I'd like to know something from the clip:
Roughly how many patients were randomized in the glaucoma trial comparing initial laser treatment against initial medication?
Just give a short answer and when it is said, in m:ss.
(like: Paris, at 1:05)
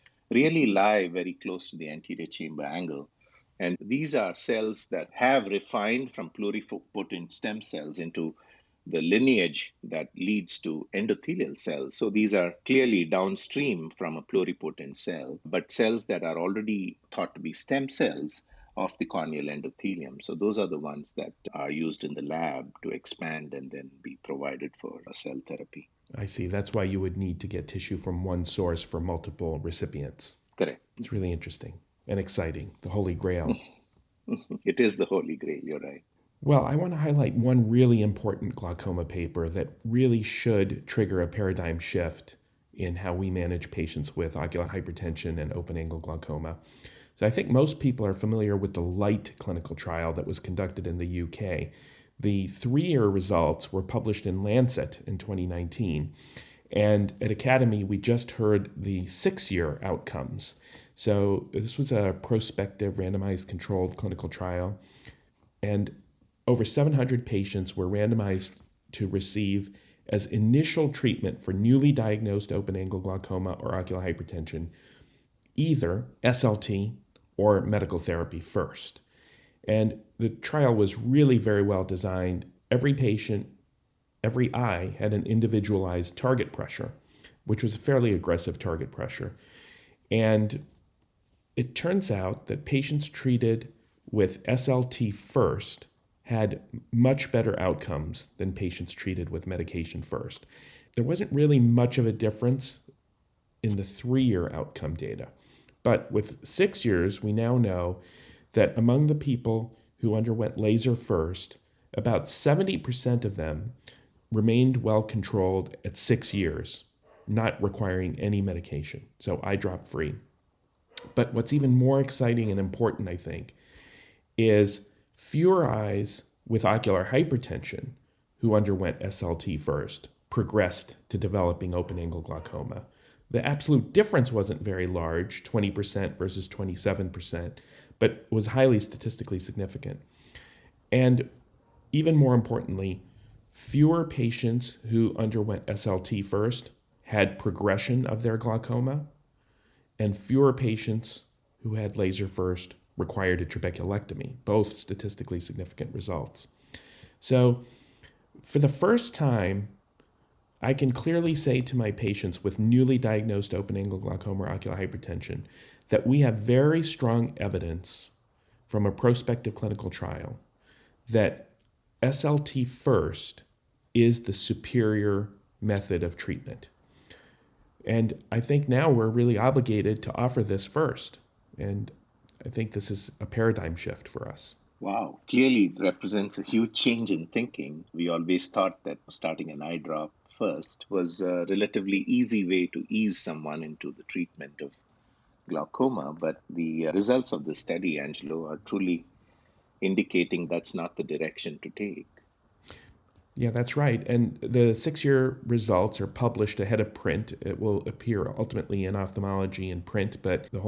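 over 700, at 1:06.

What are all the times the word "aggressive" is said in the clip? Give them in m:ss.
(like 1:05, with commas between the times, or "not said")
1:28.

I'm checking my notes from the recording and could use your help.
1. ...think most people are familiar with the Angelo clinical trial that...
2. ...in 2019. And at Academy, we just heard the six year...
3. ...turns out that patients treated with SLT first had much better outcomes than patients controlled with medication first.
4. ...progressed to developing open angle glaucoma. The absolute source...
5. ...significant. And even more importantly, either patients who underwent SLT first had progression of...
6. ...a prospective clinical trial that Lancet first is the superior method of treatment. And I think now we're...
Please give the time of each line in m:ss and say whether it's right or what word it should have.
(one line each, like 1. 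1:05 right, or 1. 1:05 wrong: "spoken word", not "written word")
1. 0:47 wrong: "LIGHT", not "Angelo"
2. 0:55 right
3. 1:31 wrong: "treated", not "controlled"
4. 2:10 wrong: "difference", not "source"
5. 2:19 wrong: "fewer", not "either"
6. 2:48 wrong: "SLT", not "Lancet".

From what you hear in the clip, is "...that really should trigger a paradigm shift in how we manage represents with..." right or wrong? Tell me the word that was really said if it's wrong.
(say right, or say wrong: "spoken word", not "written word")
wrong: "patients", not "represents".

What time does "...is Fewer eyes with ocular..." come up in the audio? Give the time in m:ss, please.
2:04.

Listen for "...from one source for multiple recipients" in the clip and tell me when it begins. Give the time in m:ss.
0:27.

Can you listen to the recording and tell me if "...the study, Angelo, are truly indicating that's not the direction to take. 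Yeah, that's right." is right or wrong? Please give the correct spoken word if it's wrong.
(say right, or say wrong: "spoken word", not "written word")
right.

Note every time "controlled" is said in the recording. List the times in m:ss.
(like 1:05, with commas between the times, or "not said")
1:03, 1:55.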